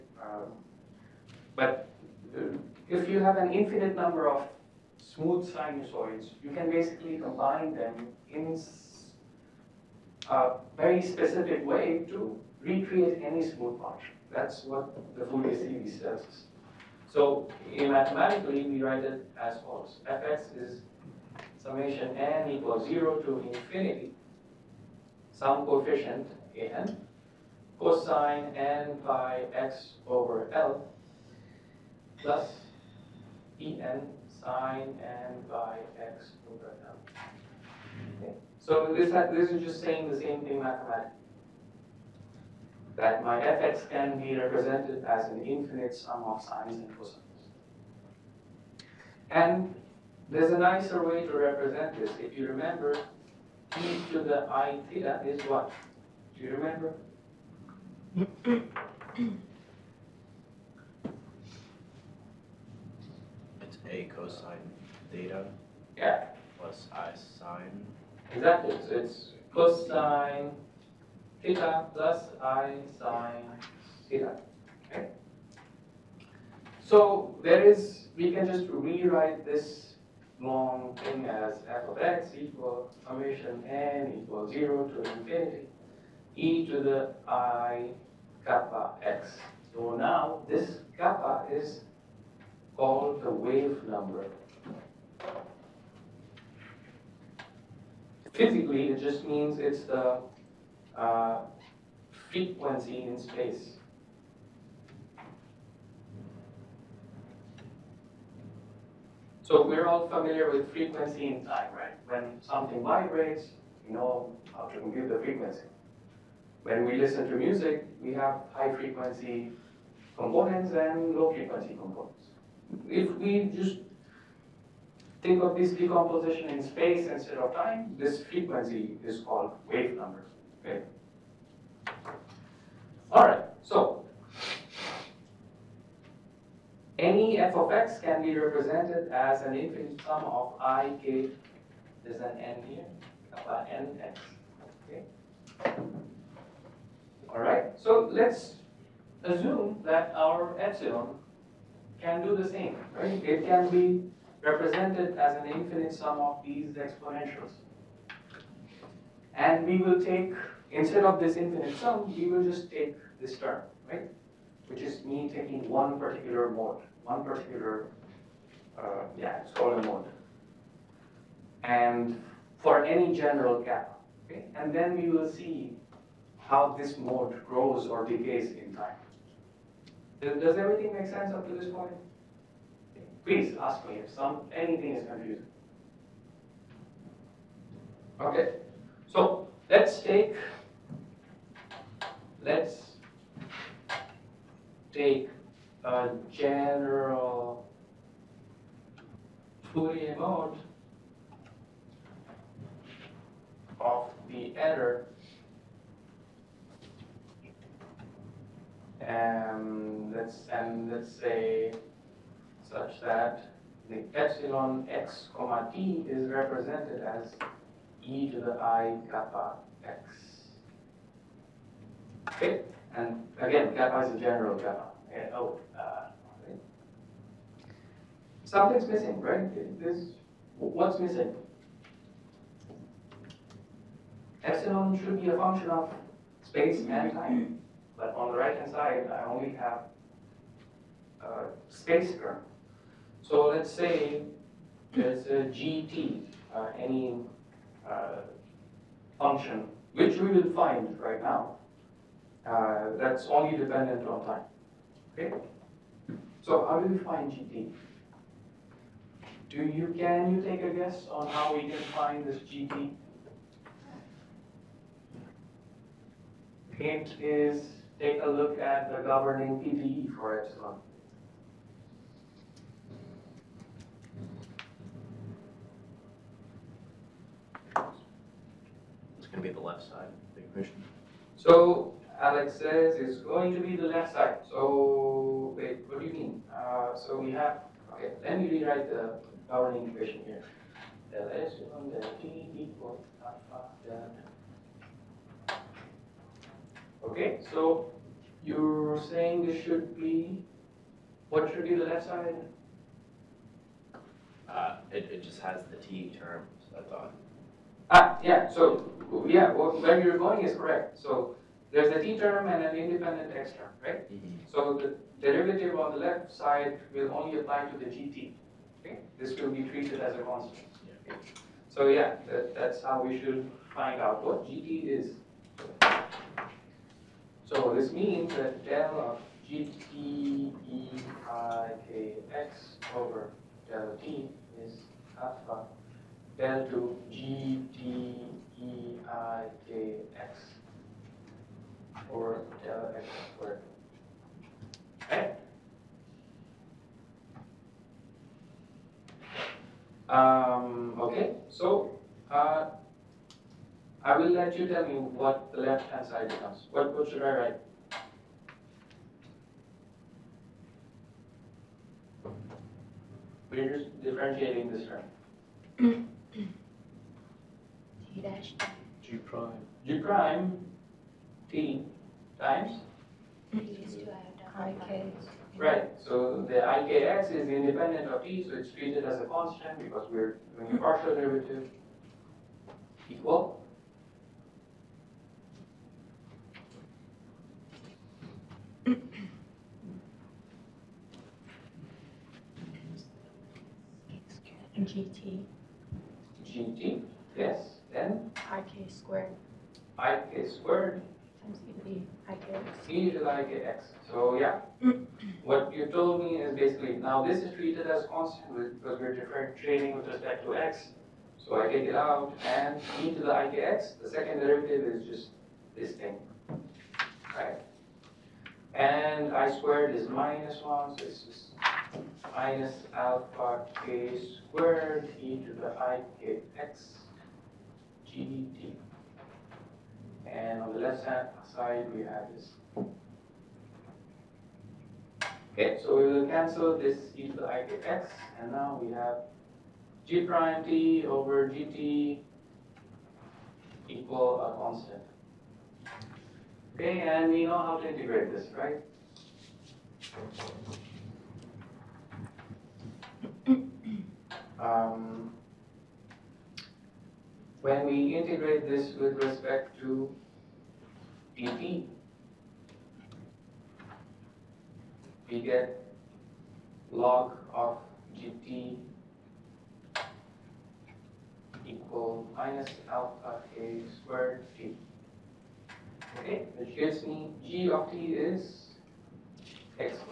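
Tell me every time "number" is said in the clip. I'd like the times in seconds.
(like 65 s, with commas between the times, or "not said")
3 s, 93 s, 129 s.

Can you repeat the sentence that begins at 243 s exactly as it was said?
So let's say there's a GT, uh, any uh, function, which we will find right now.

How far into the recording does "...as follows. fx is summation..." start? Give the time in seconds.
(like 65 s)
19 s.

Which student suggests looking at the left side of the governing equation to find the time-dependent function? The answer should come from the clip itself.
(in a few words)
Alex.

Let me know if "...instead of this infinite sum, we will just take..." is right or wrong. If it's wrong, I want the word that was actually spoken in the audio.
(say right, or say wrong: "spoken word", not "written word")
right.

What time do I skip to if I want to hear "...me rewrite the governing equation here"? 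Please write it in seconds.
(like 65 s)
288 s.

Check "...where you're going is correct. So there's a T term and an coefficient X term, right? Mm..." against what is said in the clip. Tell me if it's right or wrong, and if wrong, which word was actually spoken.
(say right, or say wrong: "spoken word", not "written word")
wrong: "independent", not "coefficient".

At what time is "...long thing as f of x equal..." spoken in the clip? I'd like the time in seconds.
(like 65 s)
80 s.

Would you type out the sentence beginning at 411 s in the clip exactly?
So I take it out and e to the IKX, the second derivative is just this thing, right?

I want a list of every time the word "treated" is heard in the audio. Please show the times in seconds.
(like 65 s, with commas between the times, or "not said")
319 s, 378 s, 407 s.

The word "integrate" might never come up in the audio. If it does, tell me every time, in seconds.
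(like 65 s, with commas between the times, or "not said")
447 s, 458 s.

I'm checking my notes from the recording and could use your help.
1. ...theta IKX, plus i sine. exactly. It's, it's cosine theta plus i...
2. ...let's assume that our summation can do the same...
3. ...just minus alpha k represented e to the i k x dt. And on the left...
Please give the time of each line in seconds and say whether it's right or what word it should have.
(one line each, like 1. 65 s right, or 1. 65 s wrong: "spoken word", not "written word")
1. 65 s wrong: "Yeah", not "IKX"
2. 148 s wrong: "epsilon", not "summation"
3. 421 s wrong: "squared", not "represented".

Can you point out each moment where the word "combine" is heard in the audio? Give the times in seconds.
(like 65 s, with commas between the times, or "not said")
7 s.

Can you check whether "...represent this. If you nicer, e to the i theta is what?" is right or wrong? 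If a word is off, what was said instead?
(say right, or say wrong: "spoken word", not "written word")
wrong: "remember", not "nicer".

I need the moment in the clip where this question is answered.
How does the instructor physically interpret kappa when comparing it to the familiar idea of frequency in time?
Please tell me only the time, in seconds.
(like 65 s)
102 s.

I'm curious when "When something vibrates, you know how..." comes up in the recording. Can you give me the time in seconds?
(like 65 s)
112 s.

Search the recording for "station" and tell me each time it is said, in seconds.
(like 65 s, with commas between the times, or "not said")
not said.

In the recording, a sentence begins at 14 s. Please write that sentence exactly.
That's what the Fourier series says.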